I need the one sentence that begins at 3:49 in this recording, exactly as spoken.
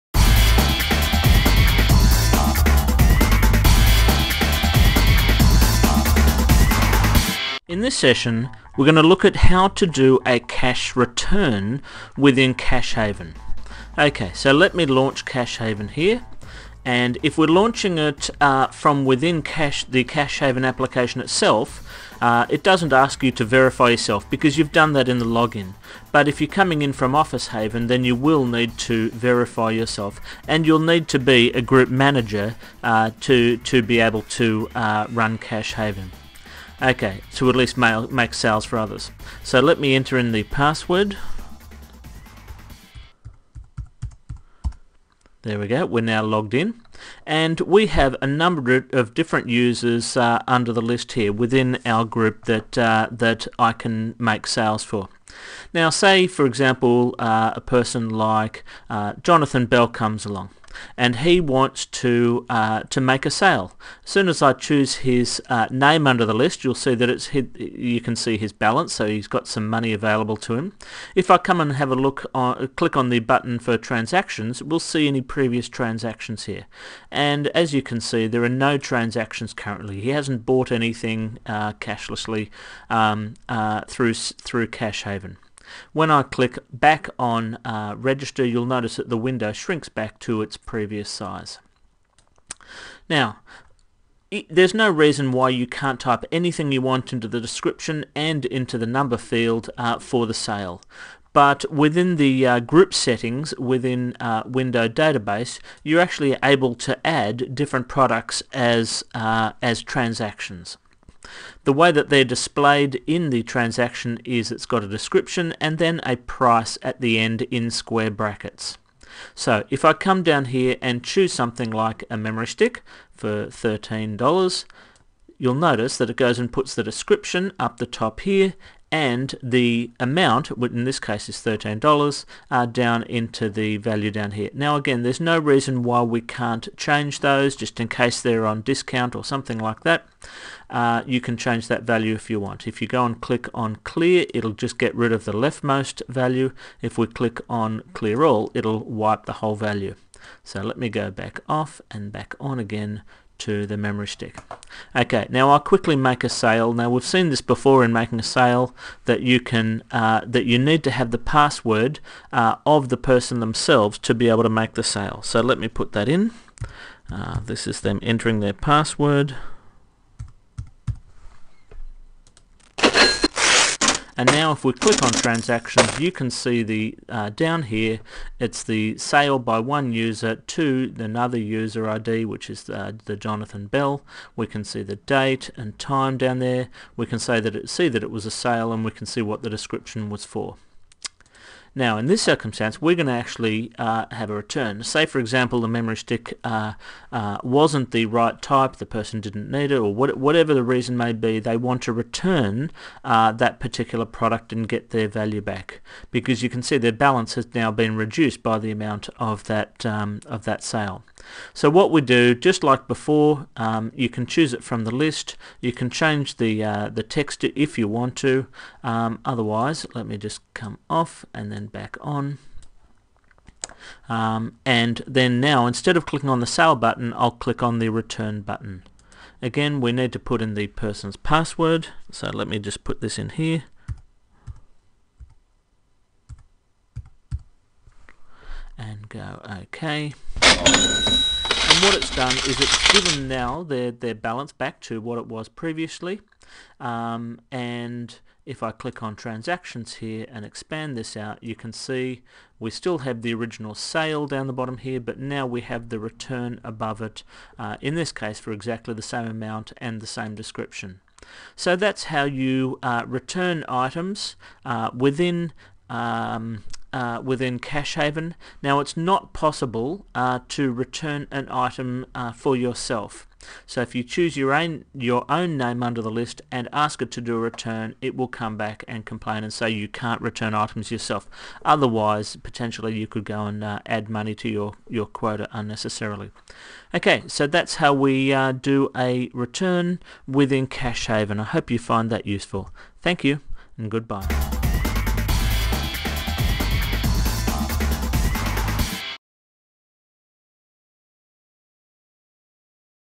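Again, we need to put in the person's password.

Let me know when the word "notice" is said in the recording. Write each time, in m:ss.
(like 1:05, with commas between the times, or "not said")
1:28, 2:05.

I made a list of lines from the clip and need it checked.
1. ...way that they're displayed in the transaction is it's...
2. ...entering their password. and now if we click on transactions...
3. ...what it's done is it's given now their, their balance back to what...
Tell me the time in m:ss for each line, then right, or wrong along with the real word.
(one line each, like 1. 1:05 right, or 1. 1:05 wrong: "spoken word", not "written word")
1. 1:51 right
2. 2:48 right
3. 4:01 right.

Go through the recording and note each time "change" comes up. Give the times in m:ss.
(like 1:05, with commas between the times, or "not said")
2:16, 2:21, 3:35.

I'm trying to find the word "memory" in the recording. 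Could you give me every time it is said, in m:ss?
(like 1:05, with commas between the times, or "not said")
2:02, 2:33, 3:15.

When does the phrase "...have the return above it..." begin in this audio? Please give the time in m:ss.
4:15.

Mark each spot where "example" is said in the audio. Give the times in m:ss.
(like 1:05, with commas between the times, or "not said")
0:56, 3:15.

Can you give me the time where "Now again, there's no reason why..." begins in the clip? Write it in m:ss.
2:14.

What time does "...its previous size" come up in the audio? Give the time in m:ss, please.
1:30.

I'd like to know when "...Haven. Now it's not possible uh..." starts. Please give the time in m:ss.
4:27.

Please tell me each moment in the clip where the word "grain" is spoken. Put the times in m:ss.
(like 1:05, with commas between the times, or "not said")
not said.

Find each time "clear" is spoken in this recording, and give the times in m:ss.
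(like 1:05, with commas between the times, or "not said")
2:23, 2:27.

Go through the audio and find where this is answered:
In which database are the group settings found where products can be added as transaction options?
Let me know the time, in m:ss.
1:44.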